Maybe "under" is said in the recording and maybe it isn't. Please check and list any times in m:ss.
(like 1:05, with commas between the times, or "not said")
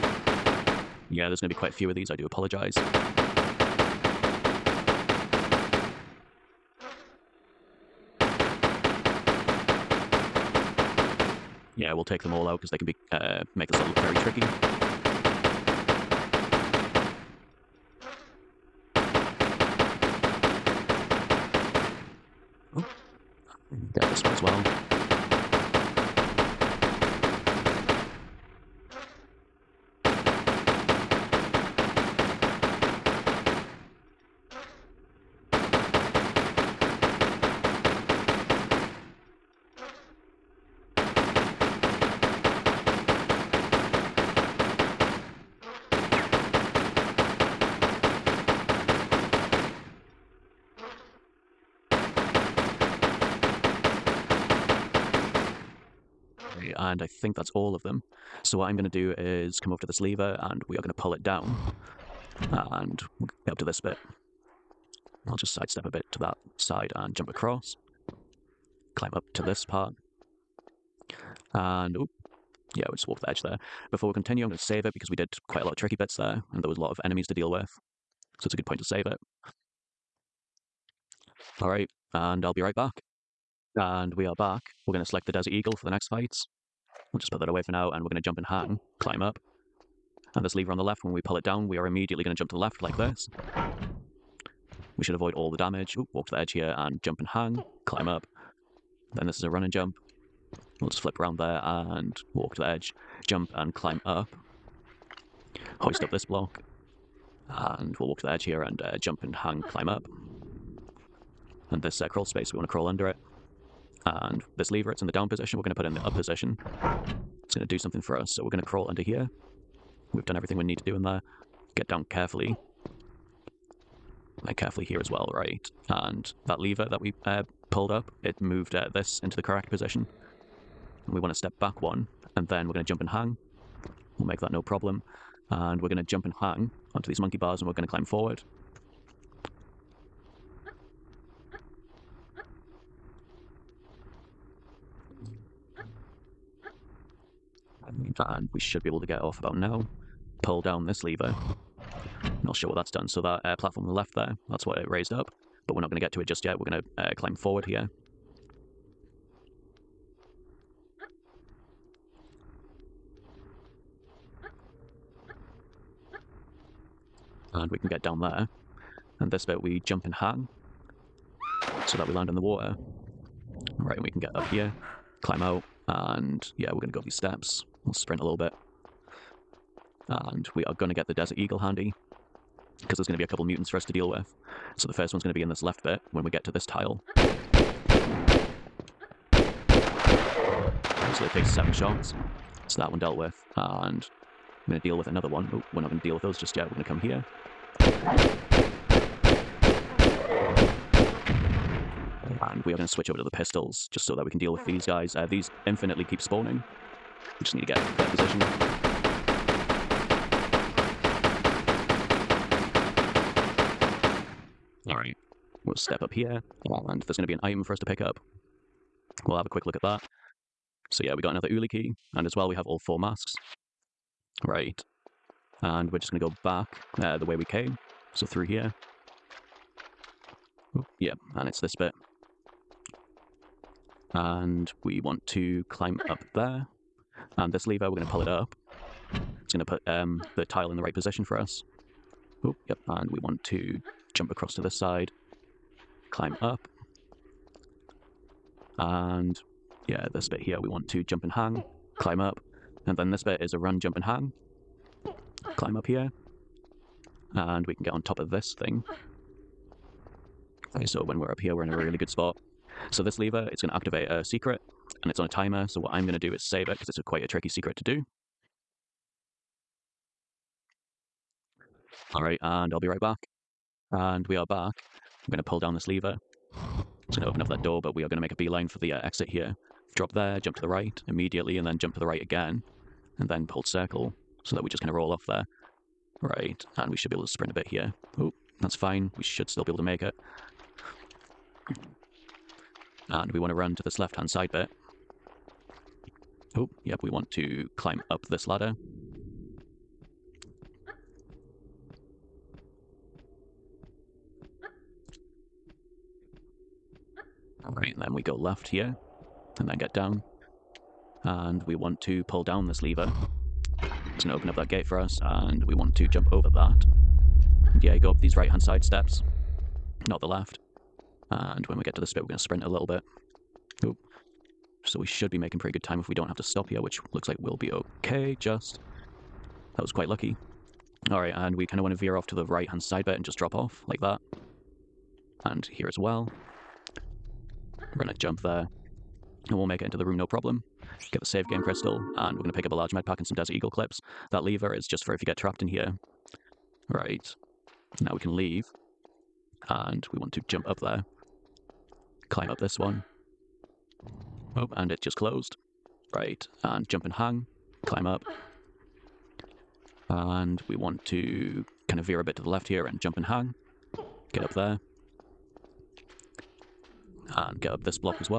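1:52, 1:58.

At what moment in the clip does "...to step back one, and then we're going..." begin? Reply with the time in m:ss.
2:11.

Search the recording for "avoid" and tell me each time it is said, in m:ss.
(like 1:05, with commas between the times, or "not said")
1:35.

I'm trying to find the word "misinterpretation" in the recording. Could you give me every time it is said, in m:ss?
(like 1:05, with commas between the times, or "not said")
not said.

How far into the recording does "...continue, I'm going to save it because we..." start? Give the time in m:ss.
1:14.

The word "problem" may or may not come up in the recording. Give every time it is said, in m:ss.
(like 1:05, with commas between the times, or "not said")
2:14, 5:40.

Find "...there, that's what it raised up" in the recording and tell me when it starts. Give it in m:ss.
2:34.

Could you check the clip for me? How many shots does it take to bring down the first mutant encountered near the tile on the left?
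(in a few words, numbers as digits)
7.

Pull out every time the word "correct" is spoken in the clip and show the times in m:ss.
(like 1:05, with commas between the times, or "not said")
2:09.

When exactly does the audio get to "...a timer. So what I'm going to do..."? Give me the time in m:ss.
4:25.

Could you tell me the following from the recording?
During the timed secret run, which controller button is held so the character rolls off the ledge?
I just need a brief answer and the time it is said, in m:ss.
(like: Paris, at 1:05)
Circle, at 4:43.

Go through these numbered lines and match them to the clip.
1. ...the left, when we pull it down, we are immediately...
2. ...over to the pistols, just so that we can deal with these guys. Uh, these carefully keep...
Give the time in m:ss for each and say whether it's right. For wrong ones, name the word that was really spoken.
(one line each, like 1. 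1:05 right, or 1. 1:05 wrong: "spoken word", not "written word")
1. 1:30 right
2. 3:23 wrong: "infinitely", not "carefully".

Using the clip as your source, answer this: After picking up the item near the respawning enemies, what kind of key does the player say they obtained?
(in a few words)
Uli key.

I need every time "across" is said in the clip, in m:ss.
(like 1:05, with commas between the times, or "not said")
1:07, 4:04.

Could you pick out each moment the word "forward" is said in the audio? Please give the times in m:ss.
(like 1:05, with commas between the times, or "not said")
2:18, 2:37.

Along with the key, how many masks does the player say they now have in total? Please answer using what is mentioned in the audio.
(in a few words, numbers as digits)
4.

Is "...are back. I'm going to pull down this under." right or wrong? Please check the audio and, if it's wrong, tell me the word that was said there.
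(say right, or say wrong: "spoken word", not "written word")
wrong: "lever", not "under".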